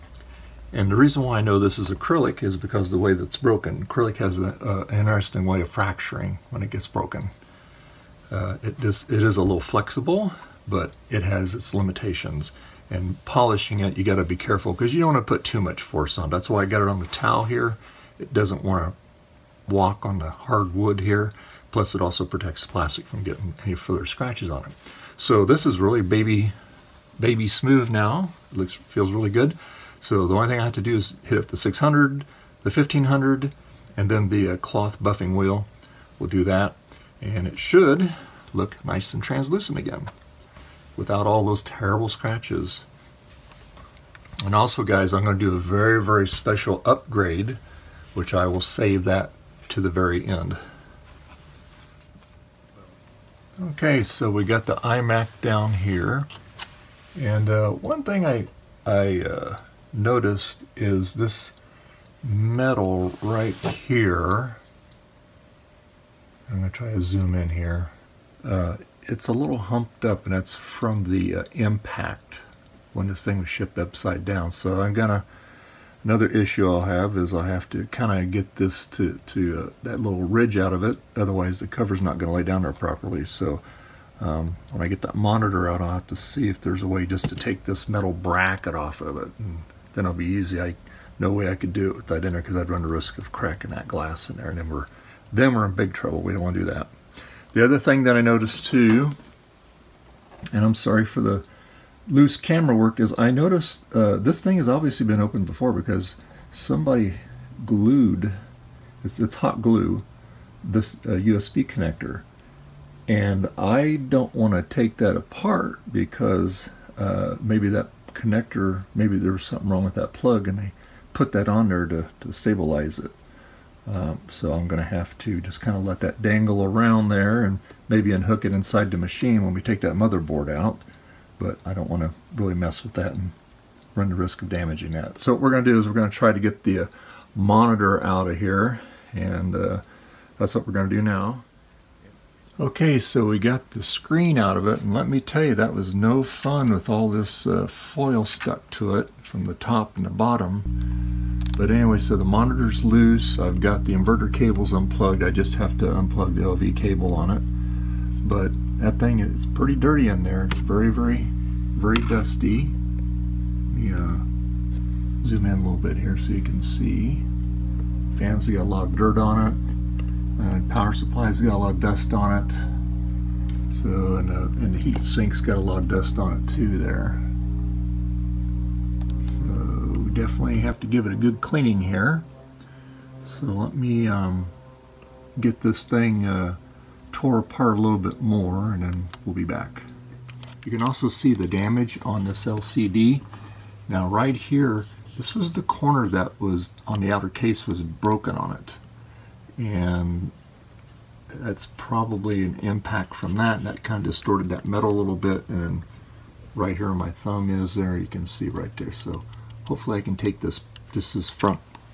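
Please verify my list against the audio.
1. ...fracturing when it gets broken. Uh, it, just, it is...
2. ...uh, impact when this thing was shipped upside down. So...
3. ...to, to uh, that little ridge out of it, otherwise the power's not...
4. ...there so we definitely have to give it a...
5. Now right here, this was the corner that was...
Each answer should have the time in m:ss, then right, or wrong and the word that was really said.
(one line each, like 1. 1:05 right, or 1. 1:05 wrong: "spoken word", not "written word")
1. 0:05 right
2. 1:11 right
3. 1:18 wrong: "cover", not "power"
4. 2:56 right
5. 3:13 right.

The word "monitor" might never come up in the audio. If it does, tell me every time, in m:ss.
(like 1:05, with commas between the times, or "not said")
1:25, 2:17, 2:32.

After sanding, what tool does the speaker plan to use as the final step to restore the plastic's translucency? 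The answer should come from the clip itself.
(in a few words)
Cloth buffing wheel.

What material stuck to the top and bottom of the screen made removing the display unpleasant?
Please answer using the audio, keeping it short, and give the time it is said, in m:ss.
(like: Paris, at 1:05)
Foil, at 2:27.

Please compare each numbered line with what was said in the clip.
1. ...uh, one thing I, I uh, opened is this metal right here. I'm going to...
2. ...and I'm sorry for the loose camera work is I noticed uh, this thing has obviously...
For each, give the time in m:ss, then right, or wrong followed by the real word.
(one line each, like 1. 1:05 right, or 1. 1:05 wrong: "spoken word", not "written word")
1. 0:57 wrong: "noticed", not "opened"
2. 1:40 right.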